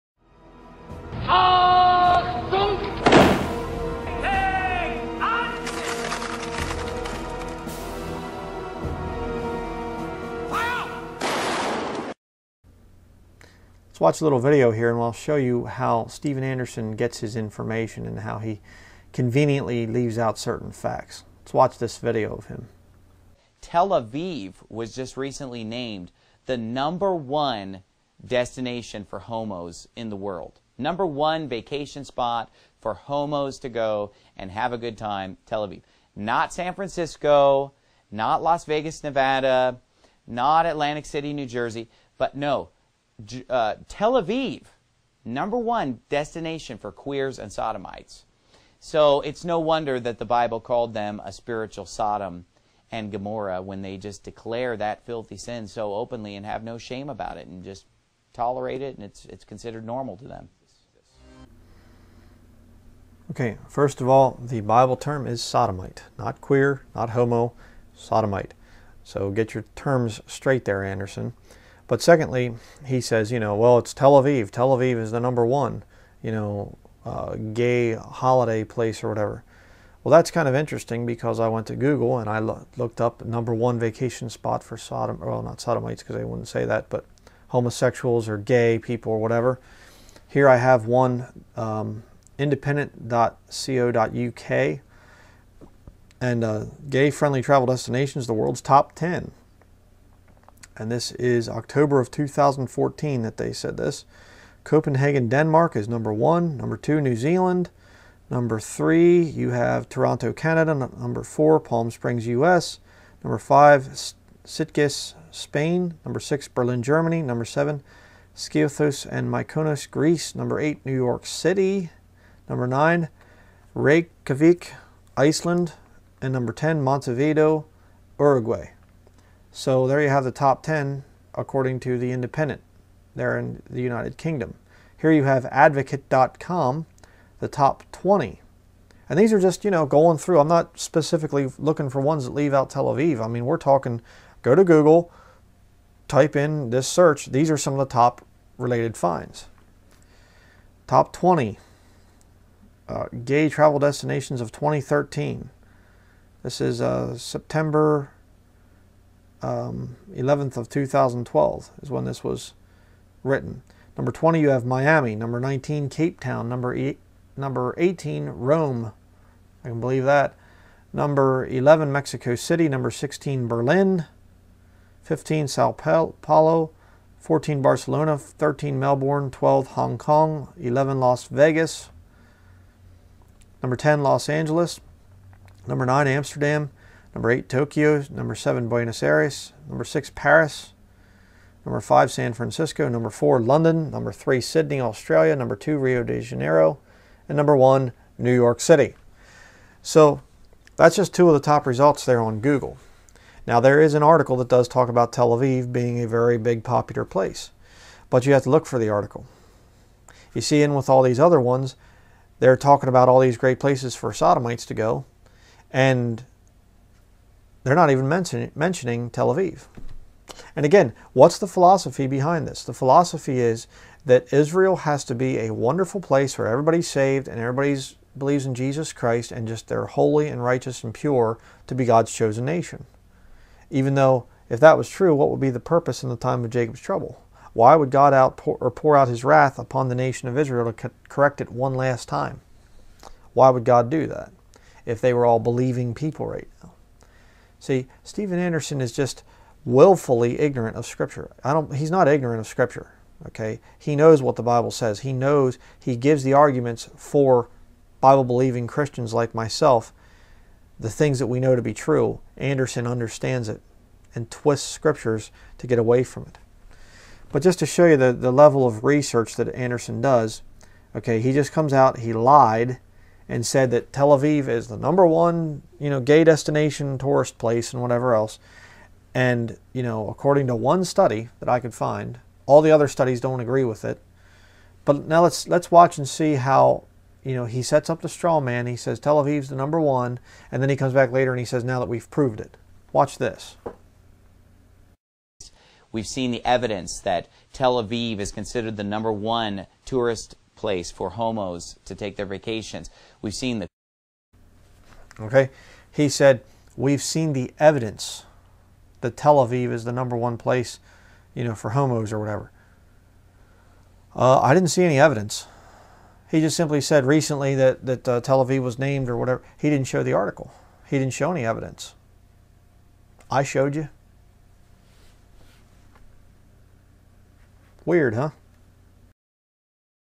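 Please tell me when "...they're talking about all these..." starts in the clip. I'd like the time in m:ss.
3:32.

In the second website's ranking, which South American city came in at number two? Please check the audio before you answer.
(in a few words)
Rio de Janeiro.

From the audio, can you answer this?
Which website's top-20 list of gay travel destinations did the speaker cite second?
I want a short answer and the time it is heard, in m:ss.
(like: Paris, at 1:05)
advocate.com, at 2:15.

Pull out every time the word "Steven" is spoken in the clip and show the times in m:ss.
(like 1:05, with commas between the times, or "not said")
0:16, 4:08.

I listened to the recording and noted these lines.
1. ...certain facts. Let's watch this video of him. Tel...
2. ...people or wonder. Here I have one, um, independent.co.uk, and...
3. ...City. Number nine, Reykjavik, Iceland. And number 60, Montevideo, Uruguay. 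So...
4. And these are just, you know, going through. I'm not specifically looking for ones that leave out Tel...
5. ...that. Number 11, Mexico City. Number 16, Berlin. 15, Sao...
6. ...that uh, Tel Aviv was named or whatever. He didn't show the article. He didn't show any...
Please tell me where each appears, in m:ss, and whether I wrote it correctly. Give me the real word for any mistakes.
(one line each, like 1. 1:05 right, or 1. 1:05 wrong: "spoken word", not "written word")
1. 0:20 right
2. 1:28 wrong: "whatever", not "wonder"
3. 2:01 wrong: "10", not "60"
4. 2:19 right
5. 2:50 right
6. 5:17 right.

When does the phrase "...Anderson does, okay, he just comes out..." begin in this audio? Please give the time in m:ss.
4:29.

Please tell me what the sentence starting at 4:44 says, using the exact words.
But now let's let's watch and see how, you know, he sets up the straw man.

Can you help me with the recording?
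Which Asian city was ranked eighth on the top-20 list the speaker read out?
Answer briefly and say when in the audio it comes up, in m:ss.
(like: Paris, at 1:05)
Tokyo, at 3:07.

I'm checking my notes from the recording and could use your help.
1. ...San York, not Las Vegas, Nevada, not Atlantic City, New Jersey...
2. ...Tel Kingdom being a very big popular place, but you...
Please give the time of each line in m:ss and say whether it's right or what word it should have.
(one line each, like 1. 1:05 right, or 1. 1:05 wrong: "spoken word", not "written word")
1. 0:36 wrong: "Francisco", not "York"
2. 3:25 wrong: "Aviv", not "Kingdom".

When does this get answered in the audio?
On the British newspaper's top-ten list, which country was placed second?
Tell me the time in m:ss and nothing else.
1:47.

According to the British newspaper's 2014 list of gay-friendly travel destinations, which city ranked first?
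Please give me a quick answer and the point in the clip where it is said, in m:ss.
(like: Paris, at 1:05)
Copenhagen, Denmark, at 1:44.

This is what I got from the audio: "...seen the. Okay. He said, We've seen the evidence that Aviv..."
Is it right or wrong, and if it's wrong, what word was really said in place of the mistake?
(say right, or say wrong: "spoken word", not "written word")
wrong: "Tel", not "Aviv".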